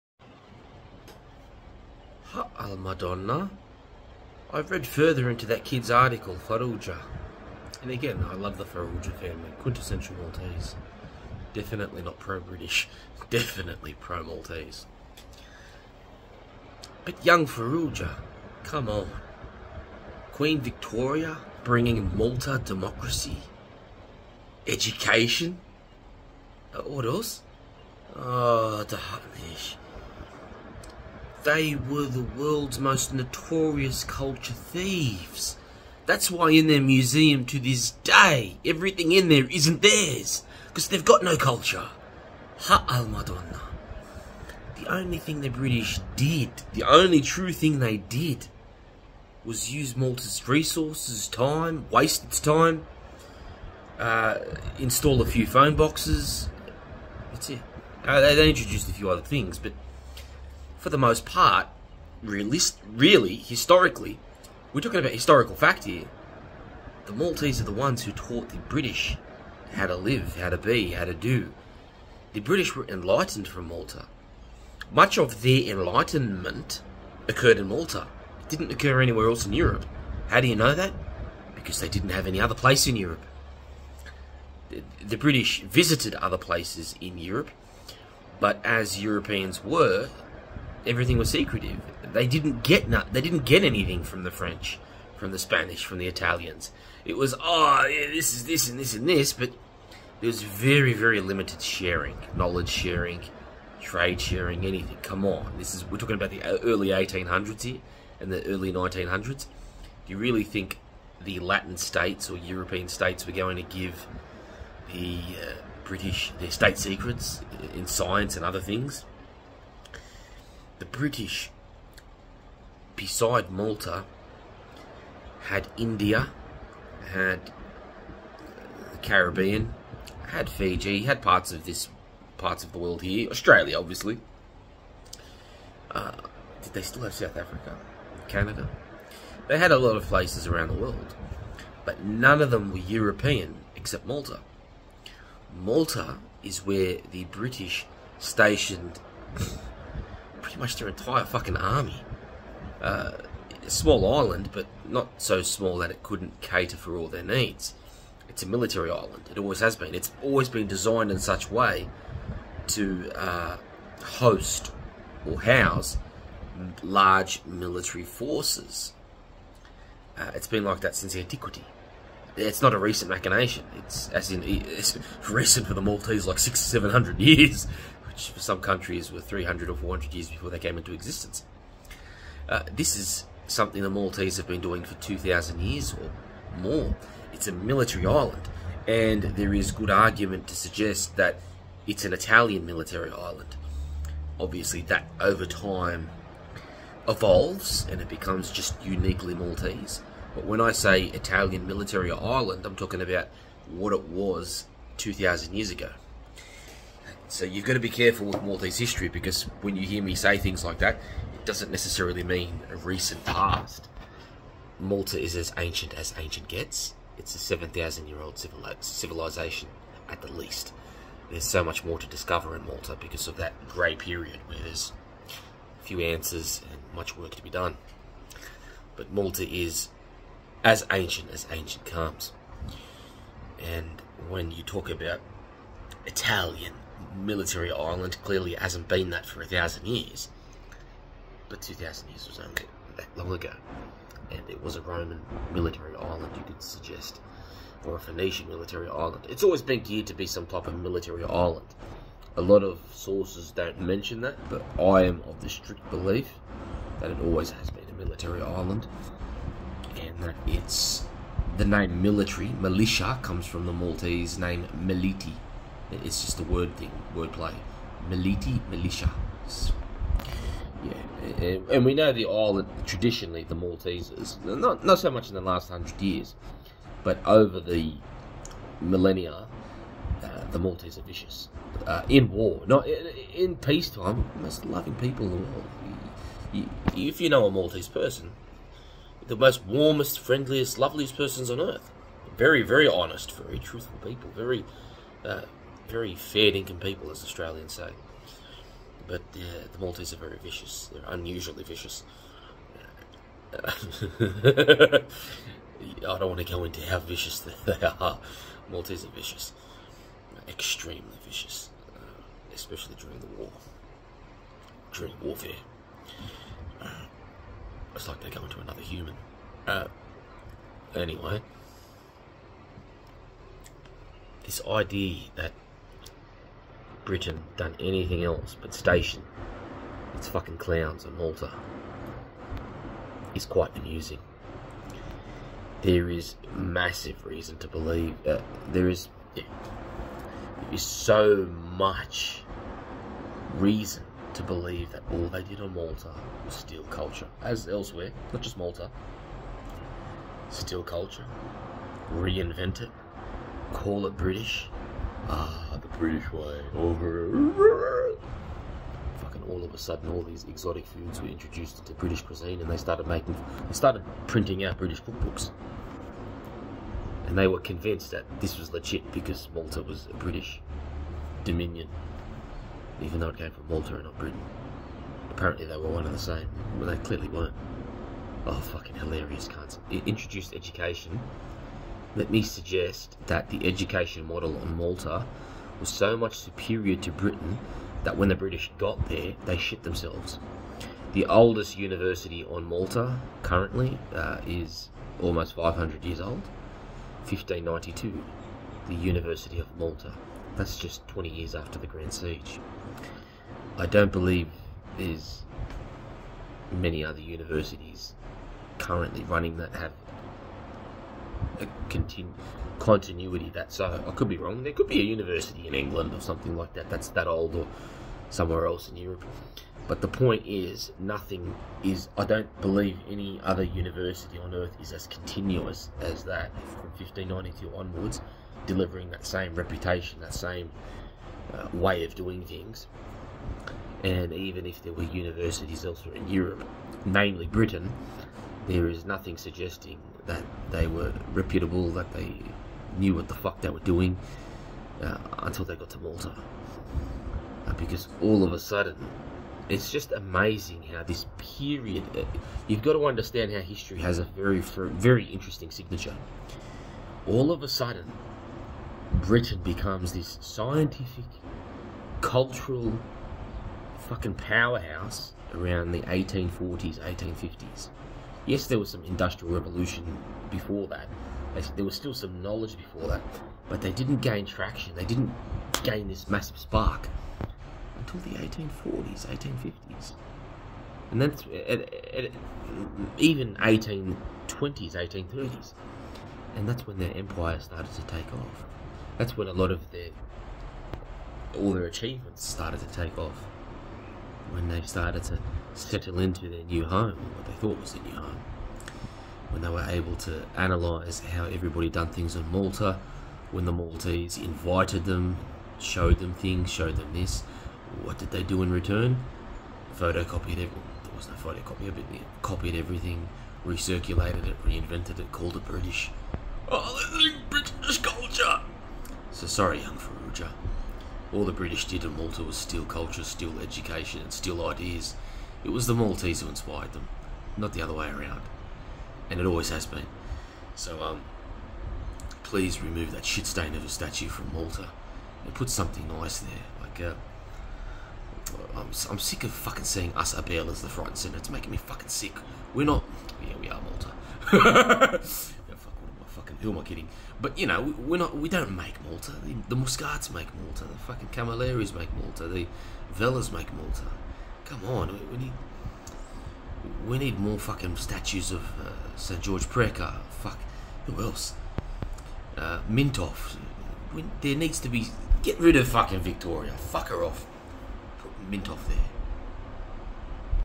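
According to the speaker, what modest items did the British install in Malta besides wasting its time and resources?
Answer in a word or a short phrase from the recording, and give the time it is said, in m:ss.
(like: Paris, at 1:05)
phone boxes, at 0:55.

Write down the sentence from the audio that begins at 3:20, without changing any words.
But when I say Italian military island, I'm talking about what it was 2,000 years ago.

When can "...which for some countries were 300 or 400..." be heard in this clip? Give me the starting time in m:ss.
2:58.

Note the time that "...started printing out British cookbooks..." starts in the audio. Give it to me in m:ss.
6:03.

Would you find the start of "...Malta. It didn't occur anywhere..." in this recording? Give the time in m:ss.
1:17.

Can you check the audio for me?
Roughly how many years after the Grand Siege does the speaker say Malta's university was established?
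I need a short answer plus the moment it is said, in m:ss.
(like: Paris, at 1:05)
20, at 6:41.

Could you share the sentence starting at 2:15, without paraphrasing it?
Uh, did they still have South Africa, Canada?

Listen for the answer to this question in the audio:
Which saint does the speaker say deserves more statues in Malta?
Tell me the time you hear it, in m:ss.
9:19.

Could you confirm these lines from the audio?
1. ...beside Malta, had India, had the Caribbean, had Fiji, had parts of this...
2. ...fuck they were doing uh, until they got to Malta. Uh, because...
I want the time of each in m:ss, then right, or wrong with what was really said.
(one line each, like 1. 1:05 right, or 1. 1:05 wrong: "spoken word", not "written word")
1. 2:02 right
2. 7:23 right.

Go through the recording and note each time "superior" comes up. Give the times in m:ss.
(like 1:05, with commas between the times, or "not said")
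6:26.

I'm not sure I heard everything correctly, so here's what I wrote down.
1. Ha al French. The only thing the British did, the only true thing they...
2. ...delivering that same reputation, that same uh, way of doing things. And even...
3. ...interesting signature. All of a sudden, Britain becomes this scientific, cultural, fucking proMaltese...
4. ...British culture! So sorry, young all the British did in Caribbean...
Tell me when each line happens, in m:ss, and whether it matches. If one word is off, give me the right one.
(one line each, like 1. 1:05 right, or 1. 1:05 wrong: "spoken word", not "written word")
1. 0:42 wrong: "Madonna", not "French"
2. 7:08 right
3. 7:35 wrong: "powerhouse", not "proMaltese"
4. 8:37 wrong: "Malta", not "Caribbean".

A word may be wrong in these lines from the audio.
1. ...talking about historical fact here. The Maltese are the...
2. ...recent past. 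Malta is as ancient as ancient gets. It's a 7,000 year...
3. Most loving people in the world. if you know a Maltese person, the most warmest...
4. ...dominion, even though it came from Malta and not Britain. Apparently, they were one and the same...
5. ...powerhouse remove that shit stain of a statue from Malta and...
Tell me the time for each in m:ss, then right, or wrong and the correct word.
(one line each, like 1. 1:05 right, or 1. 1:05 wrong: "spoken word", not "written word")
1. 1:04 right
2. 3:32 right
3. 4:44 right
4. 6:11 right
5. 8:52 wrong: "please", not "powerhouse".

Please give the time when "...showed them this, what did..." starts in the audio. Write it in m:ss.
8:26.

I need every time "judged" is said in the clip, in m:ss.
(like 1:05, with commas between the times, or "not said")
not said.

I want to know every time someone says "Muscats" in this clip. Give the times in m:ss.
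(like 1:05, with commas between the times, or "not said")
9:09.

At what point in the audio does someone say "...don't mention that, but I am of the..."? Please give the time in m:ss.
4:13.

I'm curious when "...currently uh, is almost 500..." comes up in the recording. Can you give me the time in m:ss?
6:33.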